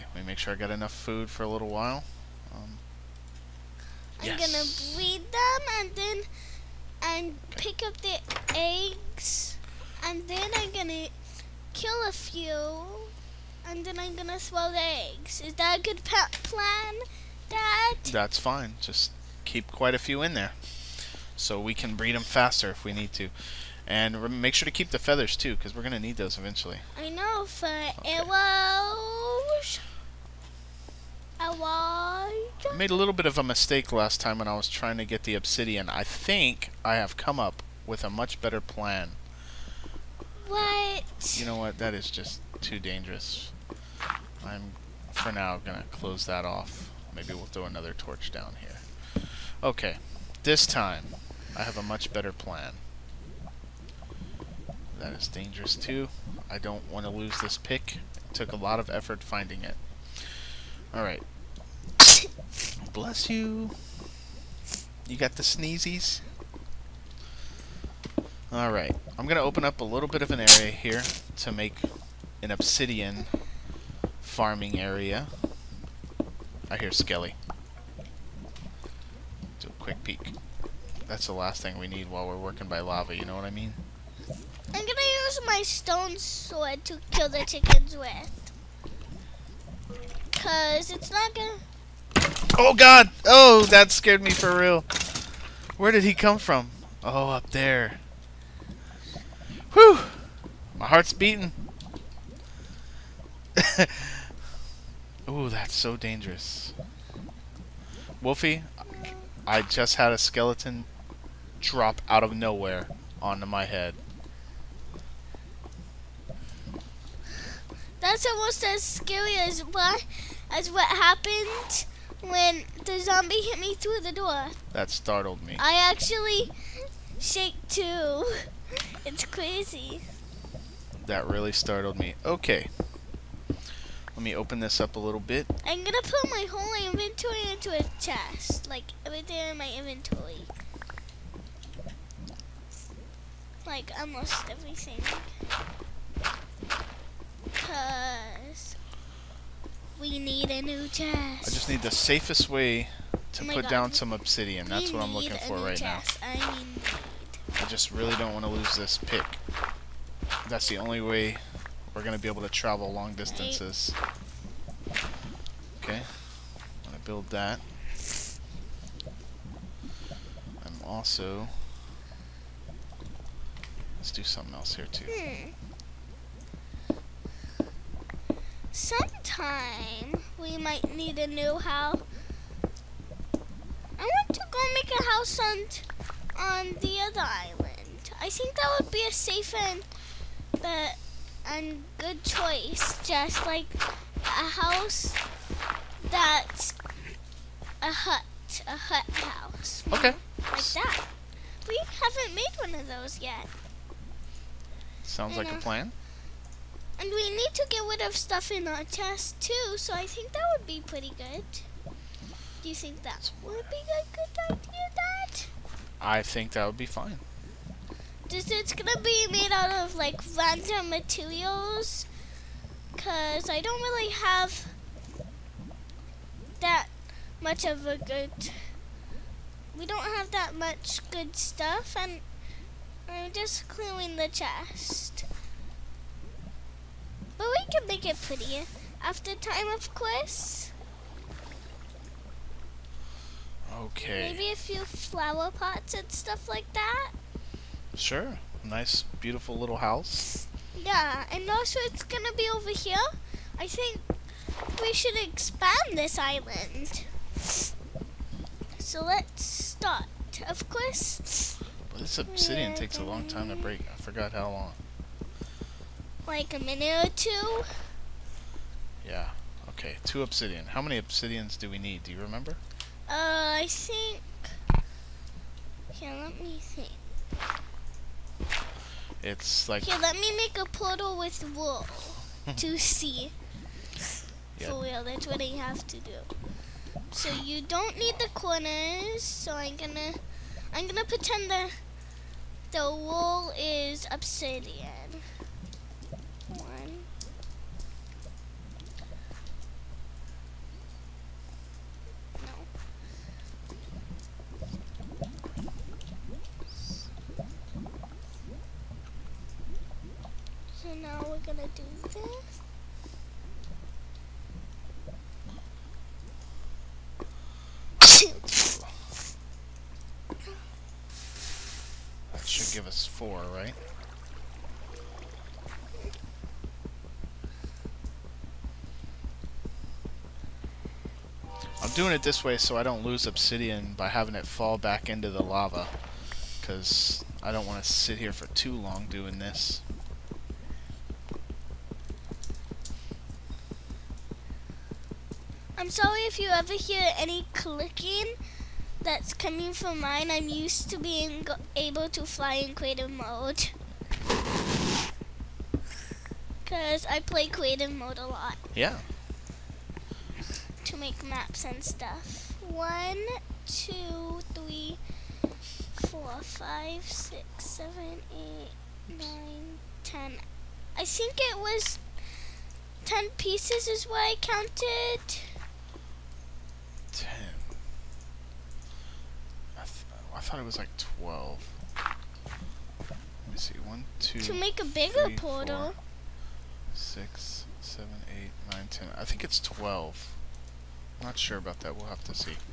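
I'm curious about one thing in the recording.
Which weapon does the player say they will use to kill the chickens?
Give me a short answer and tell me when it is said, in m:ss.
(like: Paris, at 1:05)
stone sword, at 1:25.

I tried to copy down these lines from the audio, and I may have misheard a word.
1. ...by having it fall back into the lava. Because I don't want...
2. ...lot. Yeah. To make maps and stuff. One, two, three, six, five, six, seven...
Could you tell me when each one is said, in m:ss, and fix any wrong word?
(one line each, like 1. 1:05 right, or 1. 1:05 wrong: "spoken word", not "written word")
1. 5:33 right
2. 5:58 wrong: "four", not "six".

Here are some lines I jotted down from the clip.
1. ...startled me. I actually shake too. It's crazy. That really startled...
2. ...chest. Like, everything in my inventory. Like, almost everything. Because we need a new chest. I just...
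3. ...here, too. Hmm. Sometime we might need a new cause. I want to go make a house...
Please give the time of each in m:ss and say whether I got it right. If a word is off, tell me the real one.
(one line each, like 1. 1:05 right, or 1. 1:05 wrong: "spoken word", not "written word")
1. 2:04 right
2. 2:17 right
3. 2:54 wrong: "house", not "cause".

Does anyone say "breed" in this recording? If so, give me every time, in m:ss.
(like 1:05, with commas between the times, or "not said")
0:04, 0:21.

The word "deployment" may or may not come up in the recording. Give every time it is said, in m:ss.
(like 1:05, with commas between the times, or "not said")
not said.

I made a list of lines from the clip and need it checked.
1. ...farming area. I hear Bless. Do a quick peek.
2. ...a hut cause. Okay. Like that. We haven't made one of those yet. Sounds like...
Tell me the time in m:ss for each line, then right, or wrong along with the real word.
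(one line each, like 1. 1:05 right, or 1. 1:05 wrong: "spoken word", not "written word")
1. 1:14 wrong: "Skelly", not "Bless"
2. 3:18 wrong: "house", not "cause".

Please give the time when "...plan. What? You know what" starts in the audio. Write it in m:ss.
0:38.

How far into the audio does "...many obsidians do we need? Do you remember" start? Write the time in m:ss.
4:30.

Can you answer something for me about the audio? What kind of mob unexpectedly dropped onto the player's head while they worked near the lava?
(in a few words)
skeleton.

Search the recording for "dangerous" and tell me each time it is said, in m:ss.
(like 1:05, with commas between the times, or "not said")
0:42, 0:55, 1:45.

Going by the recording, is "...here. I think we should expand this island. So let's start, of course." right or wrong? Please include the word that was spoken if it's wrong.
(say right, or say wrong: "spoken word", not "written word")
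right.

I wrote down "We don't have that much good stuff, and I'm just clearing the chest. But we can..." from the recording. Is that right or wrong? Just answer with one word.
right.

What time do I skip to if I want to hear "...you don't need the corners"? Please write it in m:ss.
4:47.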